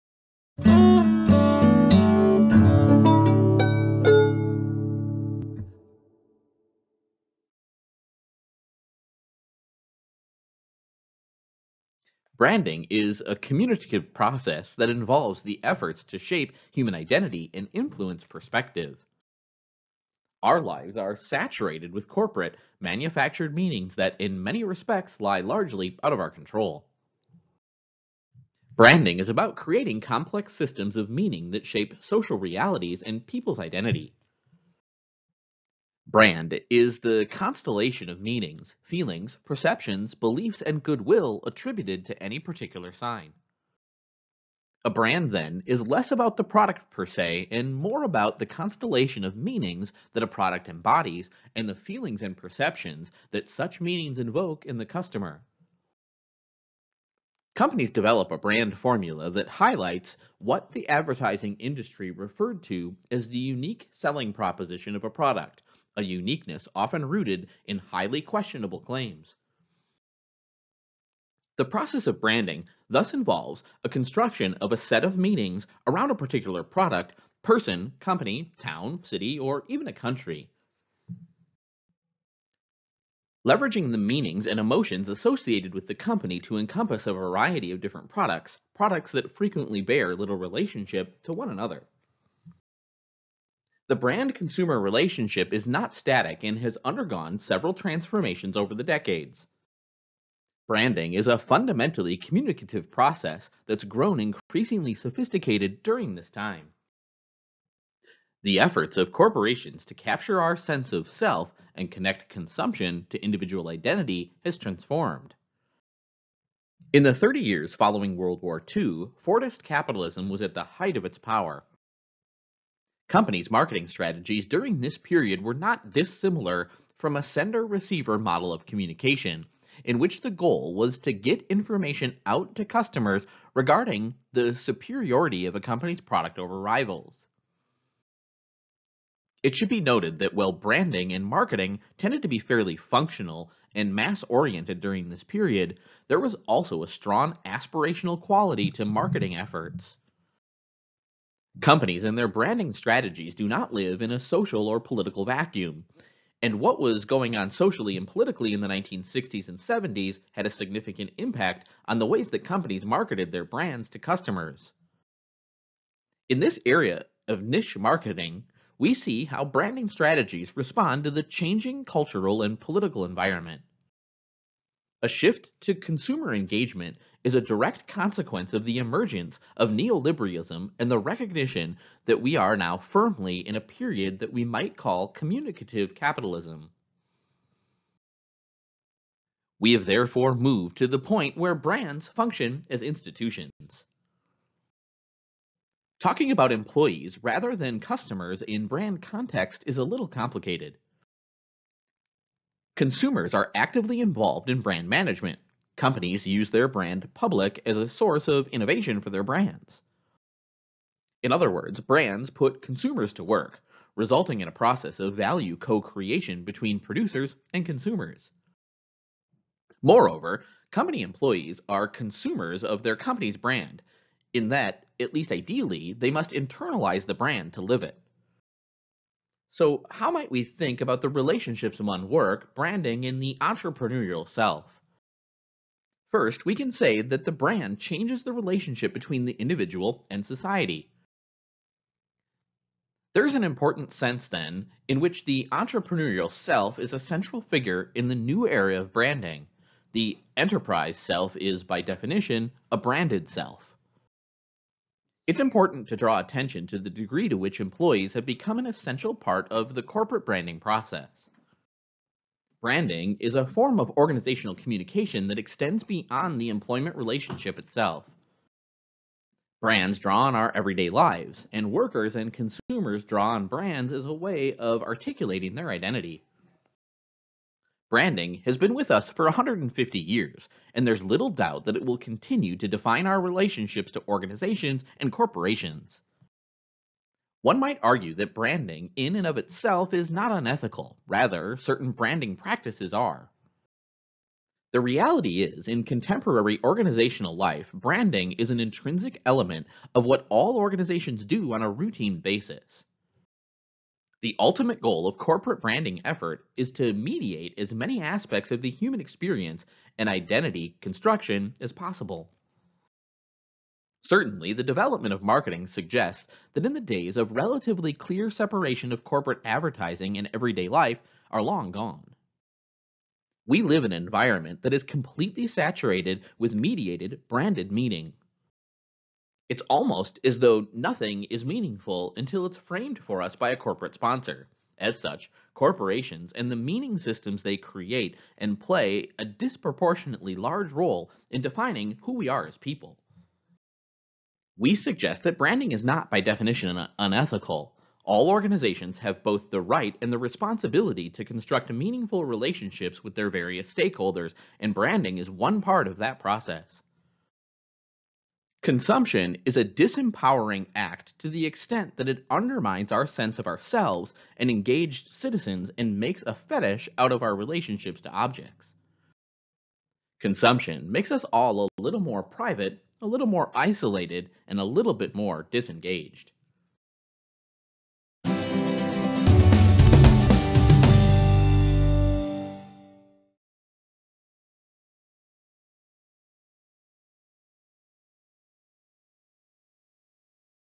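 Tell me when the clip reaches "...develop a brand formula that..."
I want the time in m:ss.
0:57.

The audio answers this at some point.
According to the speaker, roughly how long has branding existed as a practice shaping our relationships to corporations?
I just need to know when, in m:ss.
4:39.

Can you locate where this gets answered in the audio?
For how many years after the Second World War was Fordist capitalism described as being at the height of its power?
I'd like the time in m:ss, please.
1:57.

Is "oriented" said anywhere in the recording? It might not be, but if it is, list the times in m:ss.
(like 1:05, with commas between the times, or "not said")
2:24.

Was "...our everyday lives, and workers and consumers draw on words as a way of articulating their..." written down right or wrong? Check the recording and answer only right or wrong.
wrong.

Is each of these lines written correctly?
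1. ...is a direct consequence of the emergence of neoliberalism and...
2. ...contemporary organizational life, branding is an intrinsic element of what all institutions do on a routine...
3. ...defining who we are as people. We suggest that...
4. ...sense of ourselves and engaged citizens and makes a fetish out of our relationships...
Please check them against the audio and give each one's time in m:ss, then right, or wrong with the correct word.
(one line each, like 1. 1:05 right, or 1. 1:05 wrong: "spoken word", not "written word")
1. 2:57 right
2. 4:55 wrong: "organizations", not "institutions"
3. 5:41 right
4. 6:03 right.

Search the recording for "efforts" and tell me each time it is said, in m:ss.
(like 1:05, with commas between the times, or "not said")
0:15, 1:48, 2:29, 5:06.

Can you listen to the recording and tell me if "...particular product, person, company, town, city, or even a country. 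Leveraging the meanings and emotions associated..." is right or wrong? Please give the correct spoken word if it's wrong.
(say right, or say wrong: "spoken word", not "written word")
right.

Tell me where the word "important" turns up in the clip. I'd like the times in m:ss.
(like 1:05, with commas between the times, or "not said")
4:03, 4:15.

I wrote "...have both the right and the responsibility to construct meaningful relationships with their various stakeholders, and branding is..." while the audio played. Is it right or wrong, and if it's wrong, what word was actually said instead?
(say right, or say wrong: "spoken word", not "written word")
right.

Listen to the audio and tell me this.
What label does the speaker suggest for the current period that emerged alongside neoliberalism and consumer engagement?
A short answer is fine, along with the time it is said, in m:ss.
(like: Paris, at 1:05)
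communicative capitalism, at 3:05.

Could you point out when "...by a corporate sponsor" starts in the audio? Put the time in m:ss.
5:33.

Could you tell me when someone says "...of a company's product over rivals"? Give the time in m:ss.
2:15.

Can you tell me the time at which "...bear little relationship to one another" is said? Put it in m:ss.
1:29.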